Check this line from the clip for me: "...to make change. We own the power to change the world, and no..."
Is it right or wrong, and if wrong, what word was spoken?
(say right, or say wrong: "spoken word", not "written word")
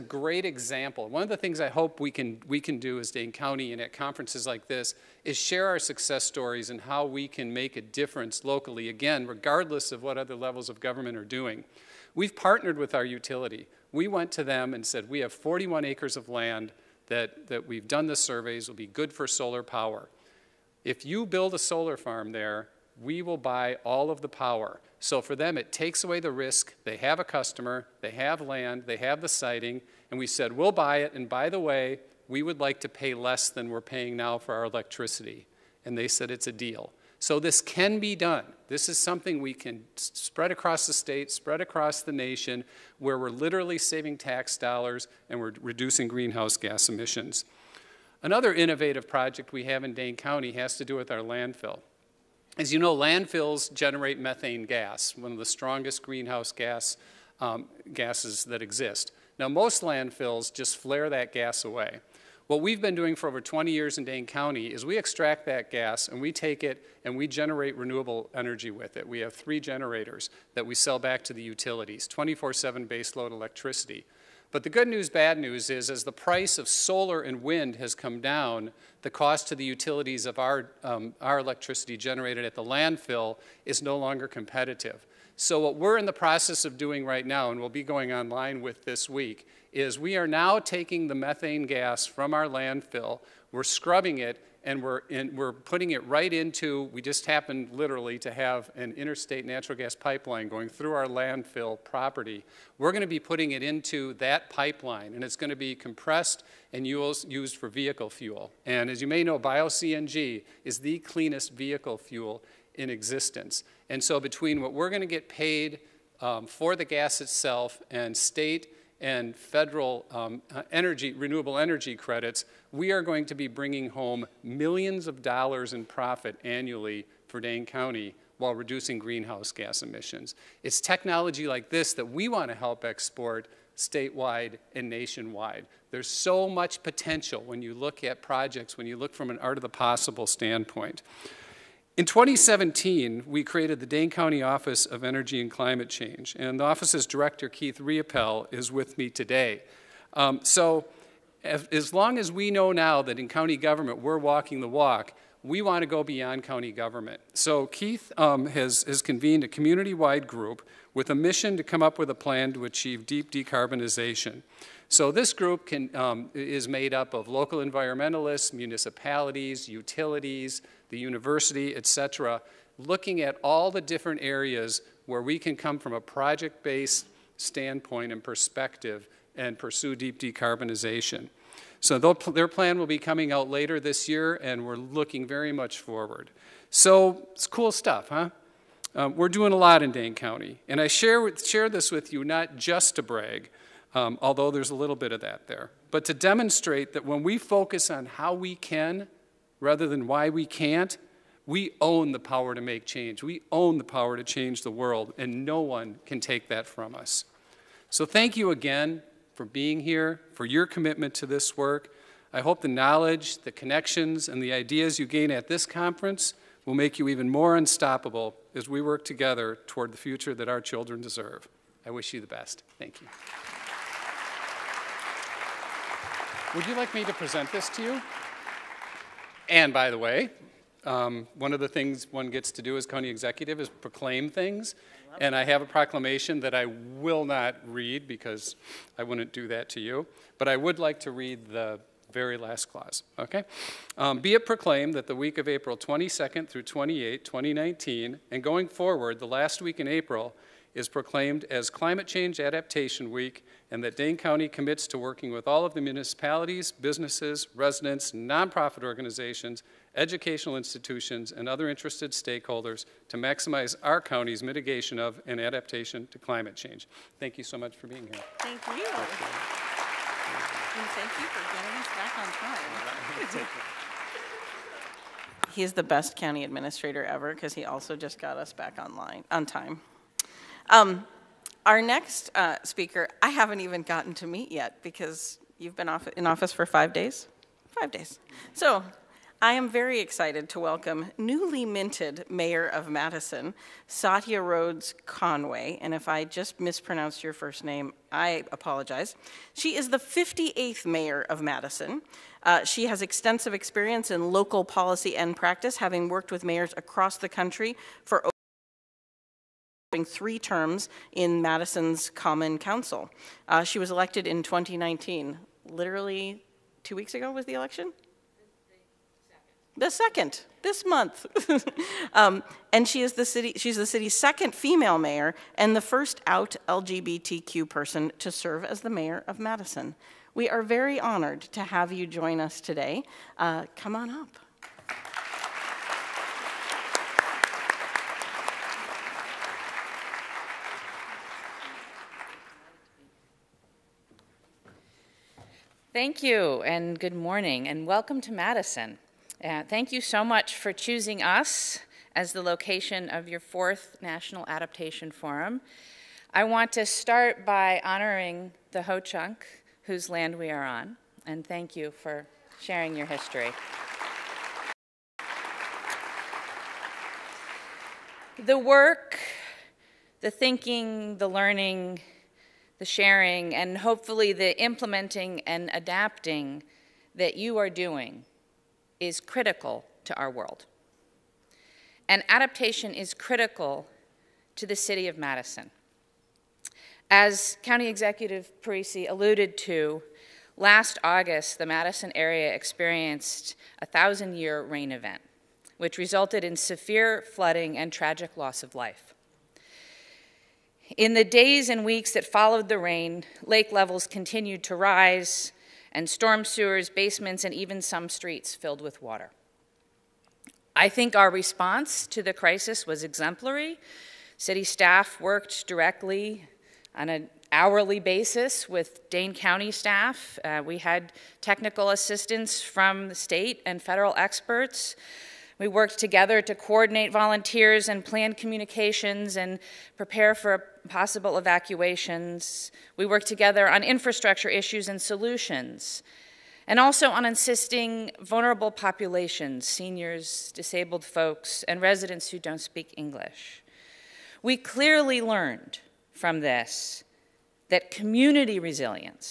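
right.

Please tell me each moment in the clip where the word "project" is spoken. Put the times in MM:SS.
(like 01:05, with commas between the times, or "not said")
00:49, 02:18, 02:56.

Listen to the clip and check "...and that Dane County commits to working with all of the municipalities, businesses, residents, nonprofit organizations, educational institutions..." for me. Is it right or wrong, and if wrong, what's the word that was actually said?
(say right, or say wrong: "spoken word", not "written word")
right.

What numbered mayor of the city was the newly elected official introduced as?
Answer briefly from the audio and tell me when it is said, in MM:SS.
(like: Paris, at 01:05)
58th, at 04:59.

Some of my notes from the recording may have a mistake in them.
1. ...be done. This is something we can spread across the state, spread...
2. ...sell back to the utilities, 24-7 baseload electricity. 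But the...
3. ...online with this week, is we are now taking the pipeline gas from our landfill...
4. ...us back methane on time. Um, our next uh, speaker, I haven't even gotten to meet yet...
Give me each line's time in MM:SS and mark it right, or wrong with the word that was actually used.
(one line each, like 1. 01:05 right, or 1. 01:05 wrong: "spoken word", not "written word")
1. 00:37 right
2. 01:10 right
3. 01:28 wrong: "methane", not "pipeline"
4. 04:38 wrong: "online", not "methane".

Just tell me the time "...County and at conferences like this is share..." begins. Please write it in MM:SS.
00:03.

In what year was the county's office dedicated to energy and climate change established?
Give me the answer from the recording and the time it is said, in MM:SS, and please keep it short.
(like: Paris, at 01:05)
2017, at 02:22.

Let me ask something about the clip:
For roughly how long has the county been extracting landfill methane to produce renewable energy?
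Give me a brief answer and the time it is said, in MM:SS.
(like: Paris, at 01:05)
over 20 years, at 01:03.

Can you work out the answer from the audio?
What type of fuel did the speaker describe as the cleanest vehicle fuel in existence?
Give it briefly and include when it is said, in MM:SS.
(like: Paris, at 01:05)
bio-CNG, at 01:49.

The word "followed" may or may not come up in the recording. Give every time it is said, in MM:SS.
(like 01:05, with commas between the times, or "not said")
06:42.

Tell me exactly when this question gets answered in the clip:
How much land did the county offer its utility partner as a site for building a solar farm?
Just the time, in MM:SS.
00:15.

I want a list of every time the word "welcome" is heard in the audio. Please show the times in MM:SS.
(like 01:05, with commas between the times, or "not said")
04:50, 05:47.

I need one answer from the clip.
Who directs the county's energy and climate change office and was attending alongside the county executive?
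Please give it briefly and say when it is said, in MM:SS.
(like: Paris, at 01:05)
Keith Reopelle, at 02:27.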